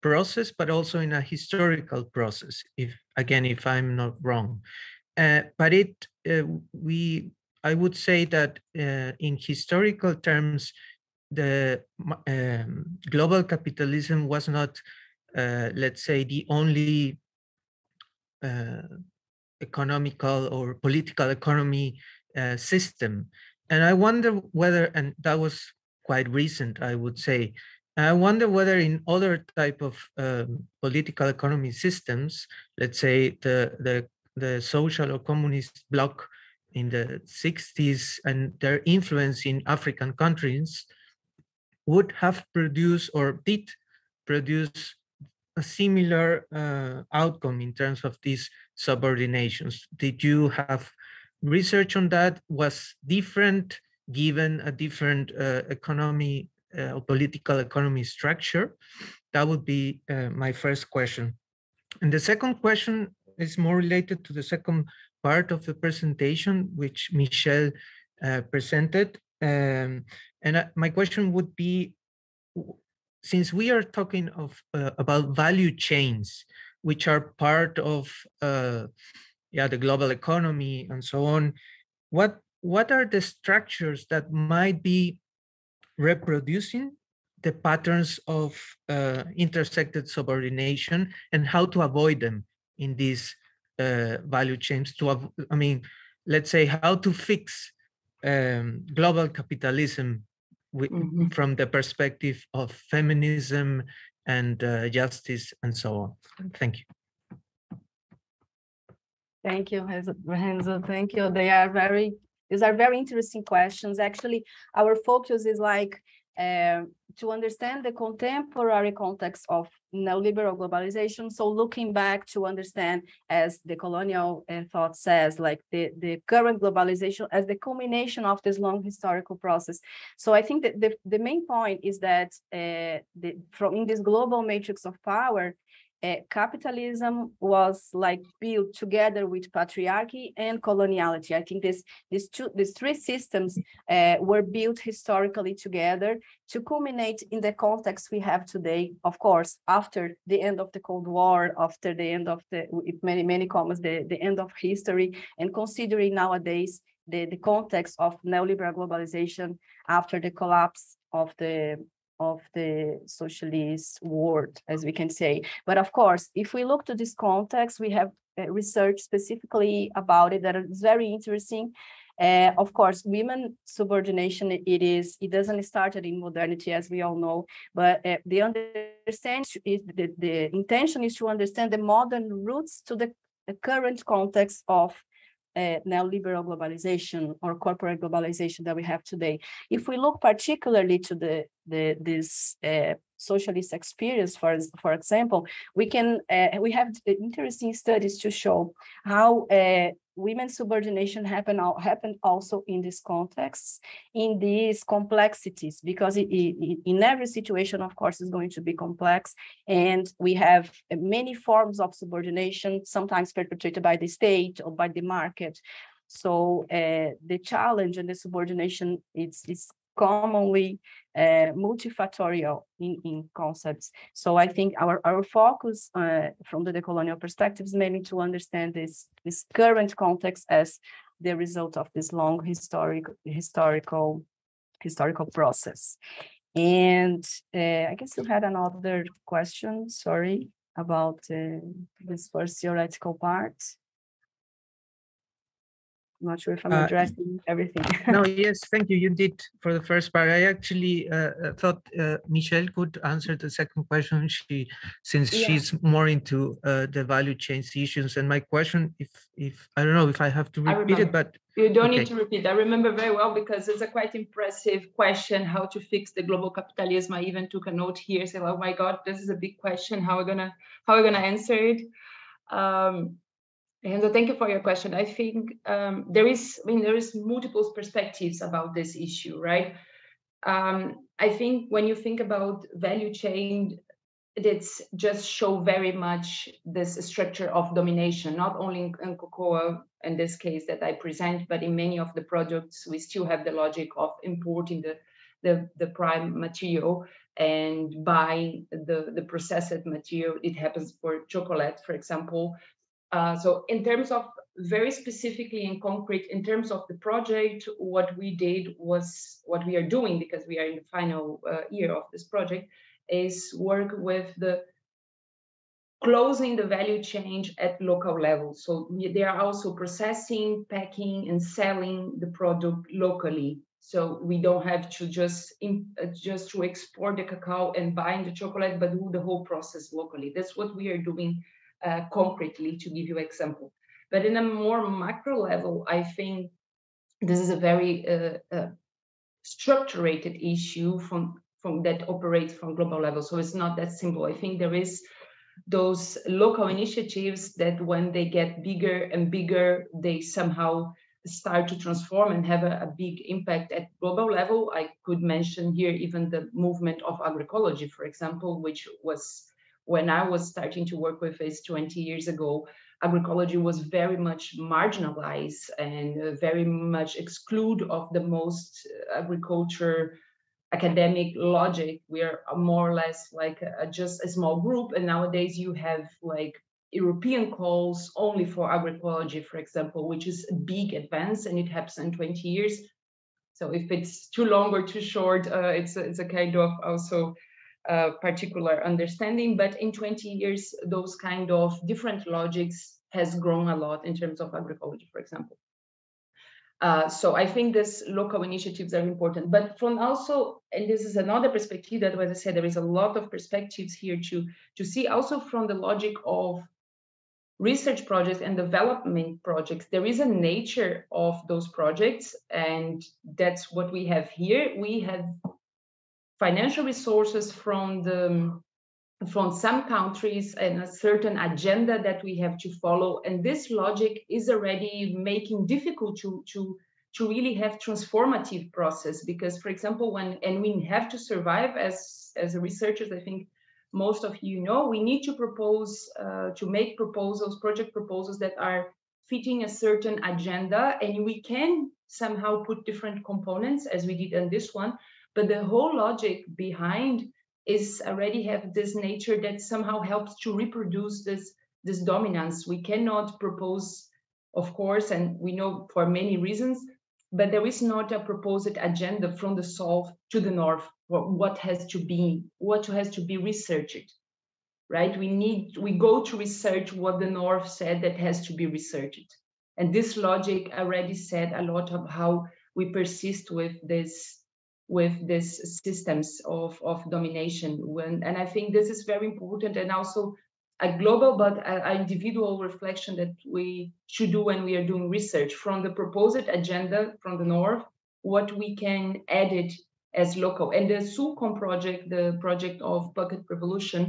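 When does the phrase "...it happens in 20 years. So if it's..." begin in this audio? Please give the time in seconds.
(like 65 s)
381 s.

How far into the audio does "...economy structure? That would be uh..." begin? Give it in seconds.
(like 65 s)
57 s.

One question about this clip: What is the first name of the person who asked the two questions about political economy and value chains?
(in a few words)
Renzo.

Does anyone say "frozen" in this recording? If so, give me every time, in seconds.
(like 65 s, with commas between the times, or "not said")
not said.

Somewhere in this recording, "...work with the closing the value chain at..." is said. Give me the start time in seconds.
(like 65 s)
313 s.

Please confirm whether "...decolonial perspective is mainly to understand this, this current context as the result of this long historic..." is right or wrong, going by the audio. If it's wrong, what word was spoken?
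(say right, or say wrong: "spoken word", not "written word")
right.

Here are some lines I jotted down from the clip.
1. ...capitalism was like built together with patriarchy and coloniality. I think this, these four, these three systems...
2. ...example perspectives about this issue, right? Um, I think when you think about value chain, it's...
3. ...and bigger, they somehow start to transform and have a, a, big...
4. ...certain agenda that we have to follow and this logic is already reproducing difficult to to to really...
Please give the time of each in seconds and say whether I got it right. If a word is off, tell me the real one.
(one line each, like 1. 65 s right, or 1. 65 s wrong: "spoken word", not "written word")
1. 136 s wrong: "two", not "four"
2. 277 s wrong: "multiple", not "example"
3. 349 s right
4. 420 s wrong: "making", not "reproducing".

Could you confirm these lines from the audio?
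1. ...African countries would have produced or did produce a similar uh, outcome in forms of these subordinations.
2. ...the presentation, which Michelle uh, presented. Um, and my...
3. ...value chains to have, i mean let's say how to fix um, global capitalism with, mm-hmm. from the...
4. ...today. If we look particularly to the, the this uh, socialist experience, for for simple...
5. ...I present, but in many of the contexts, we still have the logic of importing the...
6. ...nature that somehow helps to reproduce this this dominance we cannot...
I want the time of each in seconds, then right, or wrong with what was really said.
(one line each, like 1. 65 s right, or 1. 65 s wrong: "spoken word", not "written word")
1. 39 s wrong: "terms", not "forms"
2. 65 s right
3. 94 s right
4. 189 s wrong: "example", not "simple"
5. 290 s wrong: "products", not "contexts"
6. 448 s right.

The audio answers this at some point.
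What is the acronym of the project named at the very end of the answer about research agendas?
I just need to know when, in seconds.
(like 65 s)
491 s.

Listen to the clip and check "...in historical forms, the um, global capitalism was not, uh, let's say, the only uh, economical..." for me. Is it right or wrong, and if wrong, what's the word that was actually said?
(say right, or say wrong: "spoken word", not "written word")
wrong: "terms", not "forms".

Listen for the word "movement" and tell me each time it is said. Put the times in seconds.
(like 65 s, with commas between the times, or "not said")
356 s.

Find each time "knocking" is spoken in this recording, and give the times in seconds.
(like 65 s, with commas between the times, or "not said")
not said.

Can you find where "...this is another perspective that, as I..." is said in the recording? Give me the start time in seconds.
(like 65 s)
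400 s.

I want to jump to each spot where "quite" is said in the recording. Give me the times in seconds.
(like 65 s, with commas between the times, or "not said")
26 s, 263 s.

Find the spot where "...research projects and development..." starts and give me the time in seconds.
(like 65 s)
407 s.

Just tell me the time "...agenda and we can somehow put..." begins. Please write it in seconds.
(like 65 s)
440 s.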